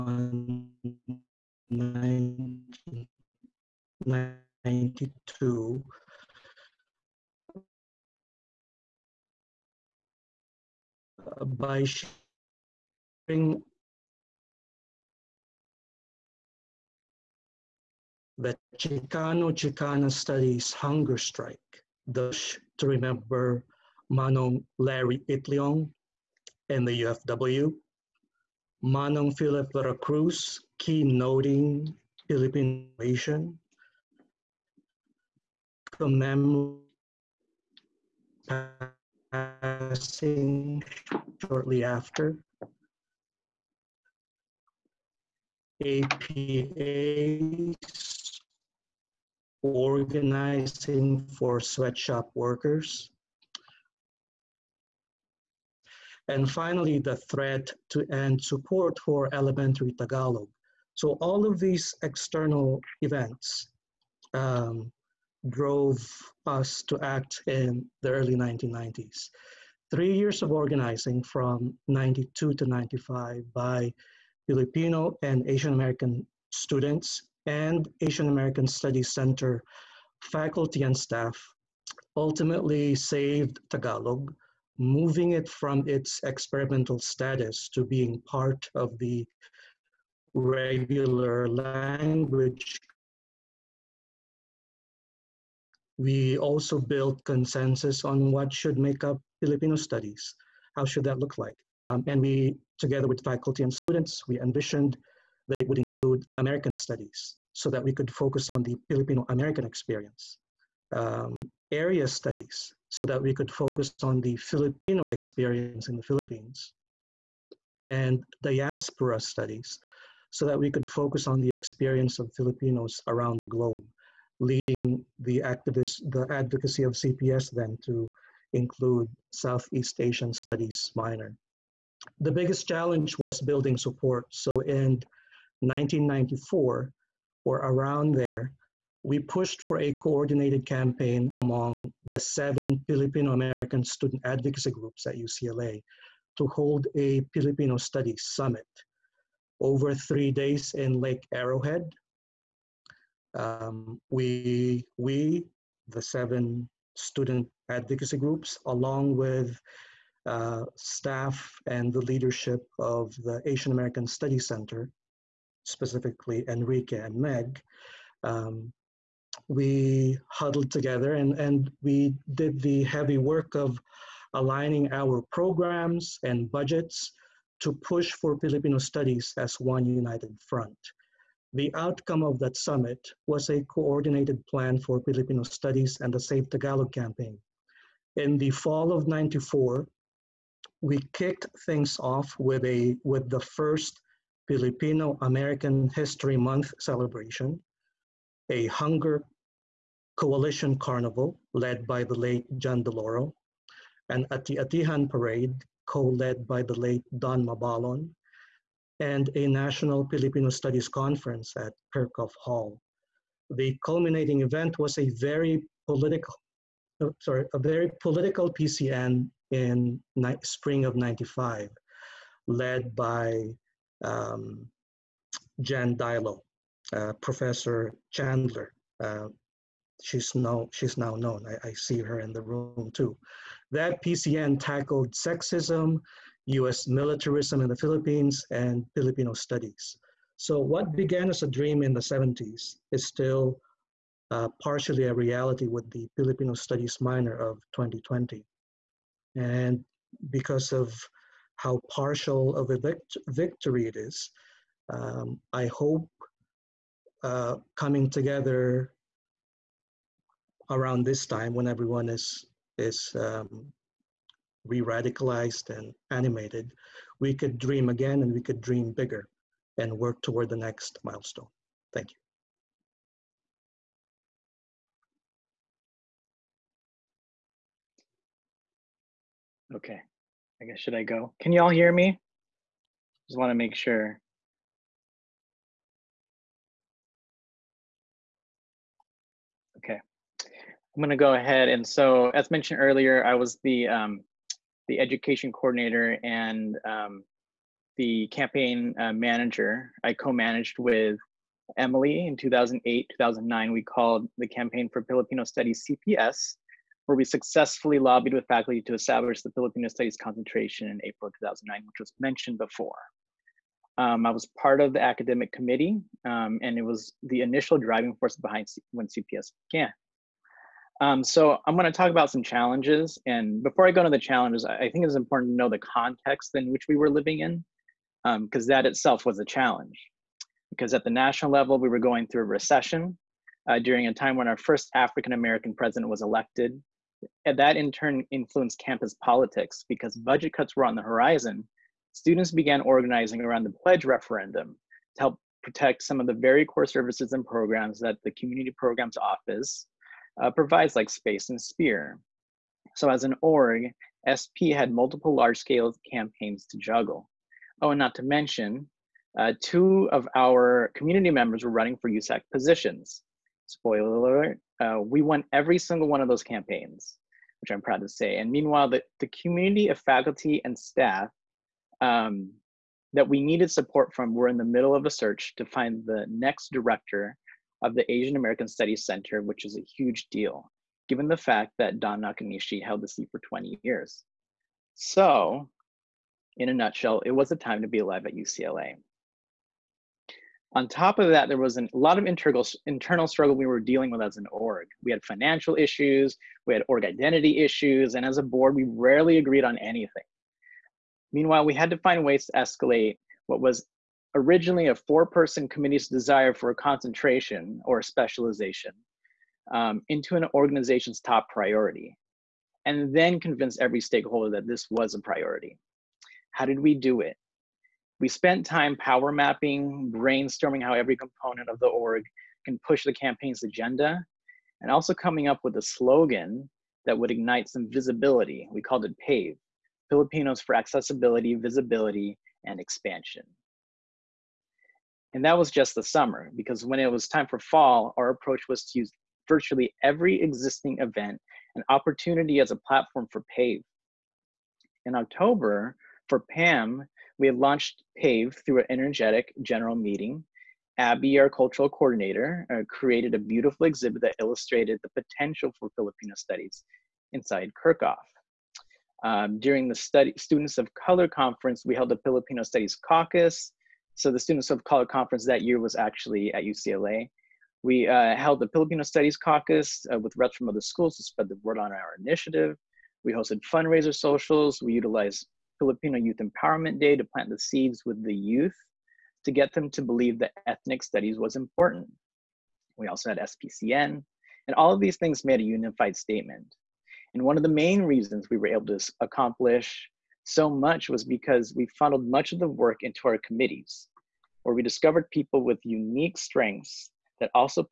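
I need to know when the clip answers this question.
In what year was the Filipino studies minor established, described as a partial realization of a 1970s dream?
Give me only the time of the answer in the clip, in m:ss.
4:07.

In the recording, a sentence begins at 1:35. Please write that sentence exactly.
We also built consensus on what should make up Filipino studies.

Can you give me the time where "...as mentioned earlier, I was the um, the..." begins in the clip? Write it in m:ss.
4:52.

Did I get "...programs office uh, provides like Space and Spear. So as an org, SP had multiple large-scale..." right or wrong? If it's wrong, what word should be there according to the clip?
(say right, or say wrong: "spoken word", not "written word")
right.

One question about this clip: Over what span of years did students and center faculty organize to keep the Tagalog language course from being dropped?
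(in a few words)
1992 to 1995.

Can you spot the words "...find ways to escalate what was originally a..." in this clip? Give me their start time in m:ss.
6:41.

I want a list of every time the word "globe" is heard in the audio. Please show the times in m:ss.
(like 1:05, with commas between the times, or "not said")
2:03.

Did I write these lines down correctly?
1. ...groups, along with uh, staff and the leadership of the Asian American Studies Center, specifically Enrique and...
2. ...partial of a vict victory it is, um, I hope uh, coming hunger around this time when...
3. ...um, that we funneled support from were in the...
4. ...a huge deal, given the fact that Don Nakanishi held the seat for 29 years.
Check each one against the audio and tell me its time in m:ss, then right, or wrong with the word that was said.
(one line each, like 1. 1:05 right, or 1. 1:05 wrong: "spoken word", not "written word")
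1. 2:38 right
2. 4:11 wrong: "together", not "hunger"
3. 6:12 wrong: "needed", not "funneled"
4. 6:19 wrong: "20", not "29".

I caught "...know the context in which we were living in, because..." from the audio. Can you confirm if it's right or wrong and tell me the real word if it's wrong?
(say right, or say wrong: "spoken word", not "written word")
right.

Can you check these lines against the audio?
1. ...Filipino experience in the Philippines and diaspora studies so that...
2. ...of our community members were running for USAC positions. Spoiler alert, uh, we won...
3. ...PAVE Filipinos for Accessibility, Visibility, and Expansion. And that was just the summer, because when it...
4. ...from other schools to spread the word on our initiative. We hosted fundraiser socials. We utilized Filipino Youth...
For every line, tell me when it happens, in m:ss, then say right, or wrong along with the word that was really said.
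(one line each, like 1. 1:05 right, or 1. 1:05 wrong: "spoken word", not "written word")
1. 1:54 right
2. 6:00 right
3. 7:09 right
4. 7:50 right.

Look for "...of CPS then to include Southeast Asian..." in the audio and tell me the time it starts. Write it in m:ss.
2:06.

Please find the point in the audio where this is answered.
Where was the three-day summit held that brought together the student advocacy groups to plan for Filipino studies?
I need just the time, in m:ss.
2:31.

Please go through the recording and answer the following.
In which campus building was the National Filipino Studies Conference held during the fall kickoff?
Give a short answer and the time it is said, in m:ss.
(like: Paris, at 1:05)
Kerckhoff Hall, at 3:31.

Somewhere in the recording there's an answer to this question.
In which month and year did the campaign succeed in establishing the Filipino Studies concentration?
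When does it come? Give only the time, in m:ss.
5:11.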